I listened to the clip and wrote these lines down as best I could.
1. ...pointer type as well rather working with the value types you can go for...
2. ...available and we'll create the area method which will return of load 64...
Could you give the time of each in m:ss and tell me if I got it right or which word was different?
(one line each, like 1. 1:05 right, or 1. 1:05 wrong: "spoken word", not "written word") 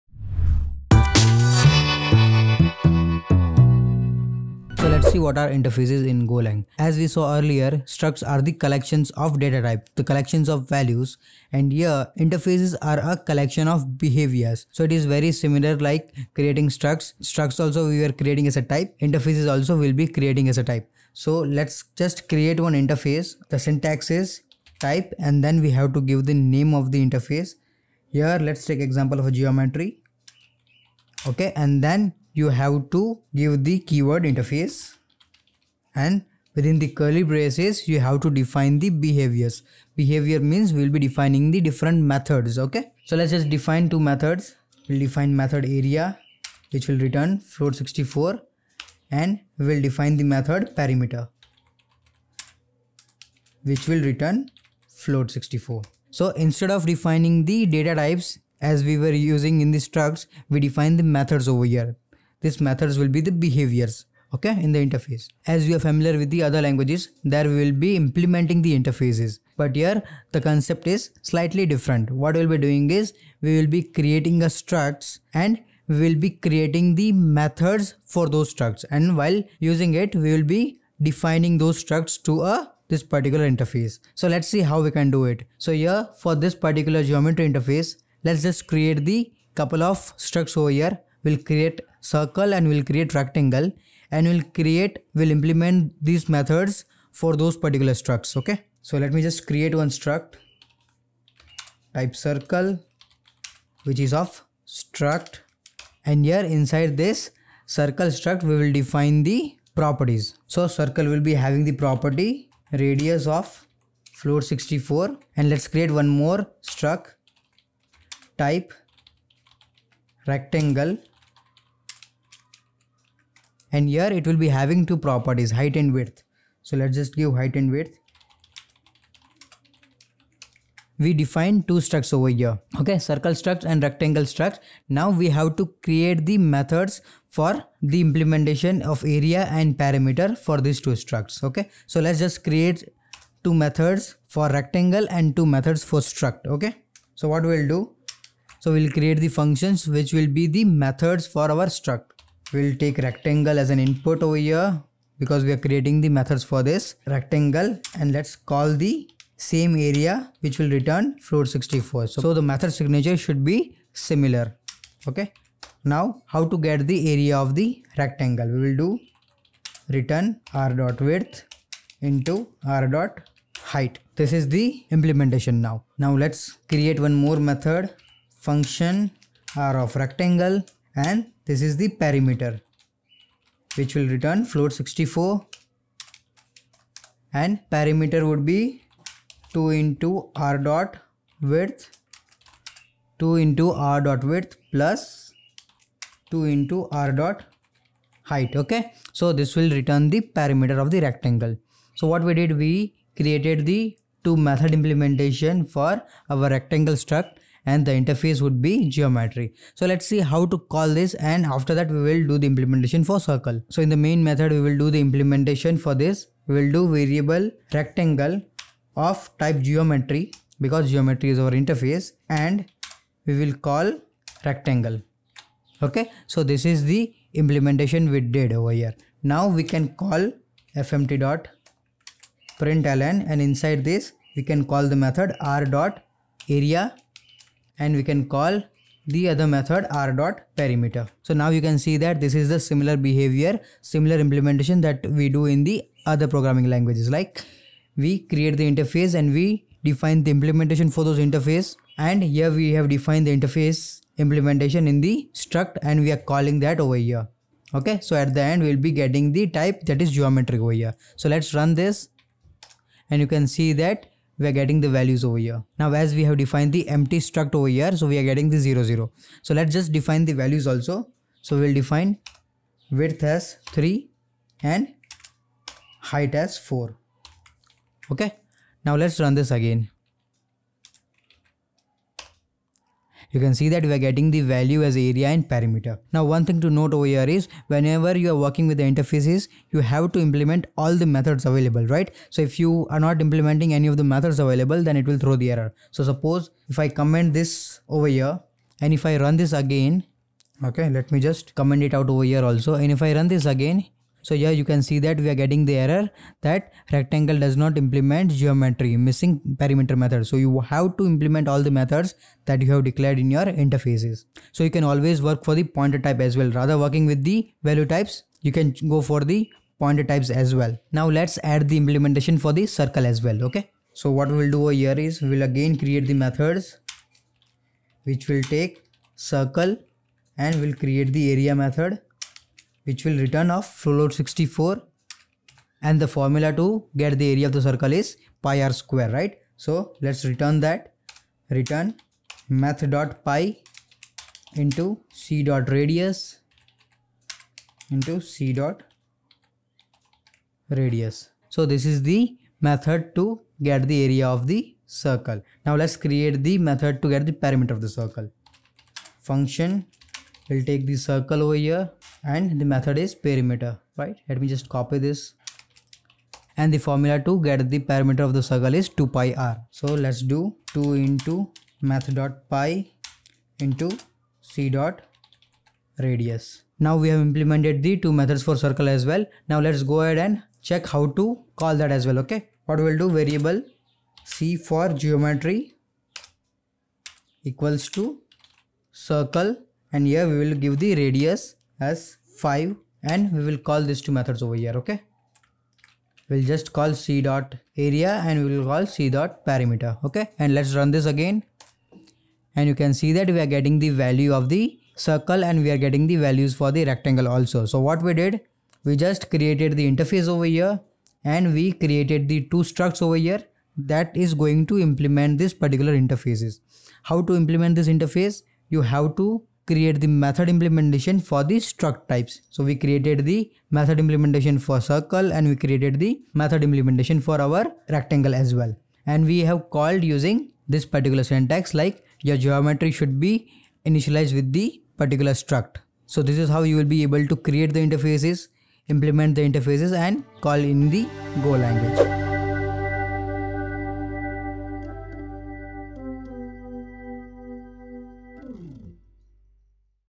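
1. 5:15 right
2. 5:29 wrong: "circle", not "available".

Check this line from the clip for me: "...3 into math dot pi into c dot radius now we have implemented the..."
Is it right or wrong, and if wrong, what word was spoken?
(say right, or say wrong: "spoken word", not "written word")
wrong: "2", not "3".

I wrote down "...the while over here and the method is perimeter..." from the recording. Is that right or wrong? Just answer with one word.
wrong.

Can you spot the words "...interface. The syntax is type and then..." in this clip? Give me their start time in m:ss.
0:22.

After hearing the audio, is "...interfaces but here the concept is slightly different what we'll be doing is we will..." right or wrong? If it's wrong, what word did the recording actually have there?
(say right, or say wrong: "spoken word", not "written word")
right.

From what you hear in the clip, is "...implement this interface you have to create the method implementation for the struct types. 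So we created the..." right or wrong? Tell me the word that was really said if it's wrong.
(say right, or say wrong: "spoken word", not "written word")
right.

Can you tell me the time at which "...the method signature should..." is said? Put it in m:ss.
2:42.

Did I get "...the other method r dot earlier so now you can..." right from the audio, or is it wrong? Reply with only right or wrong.
wrong.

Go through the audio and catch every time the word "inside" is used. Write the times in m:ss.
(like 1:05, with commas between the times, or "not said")
1:46, 3:53.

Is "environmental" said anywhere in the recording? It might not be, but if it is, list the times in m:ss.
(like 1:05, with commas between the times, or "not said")
not said.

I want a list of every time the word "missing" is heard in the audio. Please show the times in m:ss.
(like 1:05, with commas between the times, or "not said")
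5:08.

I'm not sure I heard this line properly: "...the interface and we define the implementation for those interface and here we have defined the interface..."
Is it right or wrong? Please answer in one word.
right.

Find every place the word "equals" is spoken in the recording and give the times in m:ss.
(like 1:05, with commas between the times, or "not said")
6:27.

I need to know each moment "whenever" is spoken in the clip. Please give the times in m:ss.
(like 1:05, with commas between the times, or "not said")
4:47.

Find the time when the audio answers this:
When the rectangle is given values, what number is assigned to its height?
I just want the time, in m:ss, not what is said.
4:36.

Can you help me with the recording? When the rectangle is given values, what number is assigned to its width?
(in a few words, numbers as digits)
3.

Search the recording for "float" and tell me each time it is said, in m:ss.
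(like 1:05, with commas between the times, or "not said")
0:47, 0:54, 1:54, 2:41, 3:04.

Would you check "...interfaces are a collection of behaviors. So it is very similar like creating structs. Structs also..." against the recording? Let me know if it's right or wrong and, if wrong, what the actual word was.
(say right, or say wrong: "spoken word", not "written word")
right.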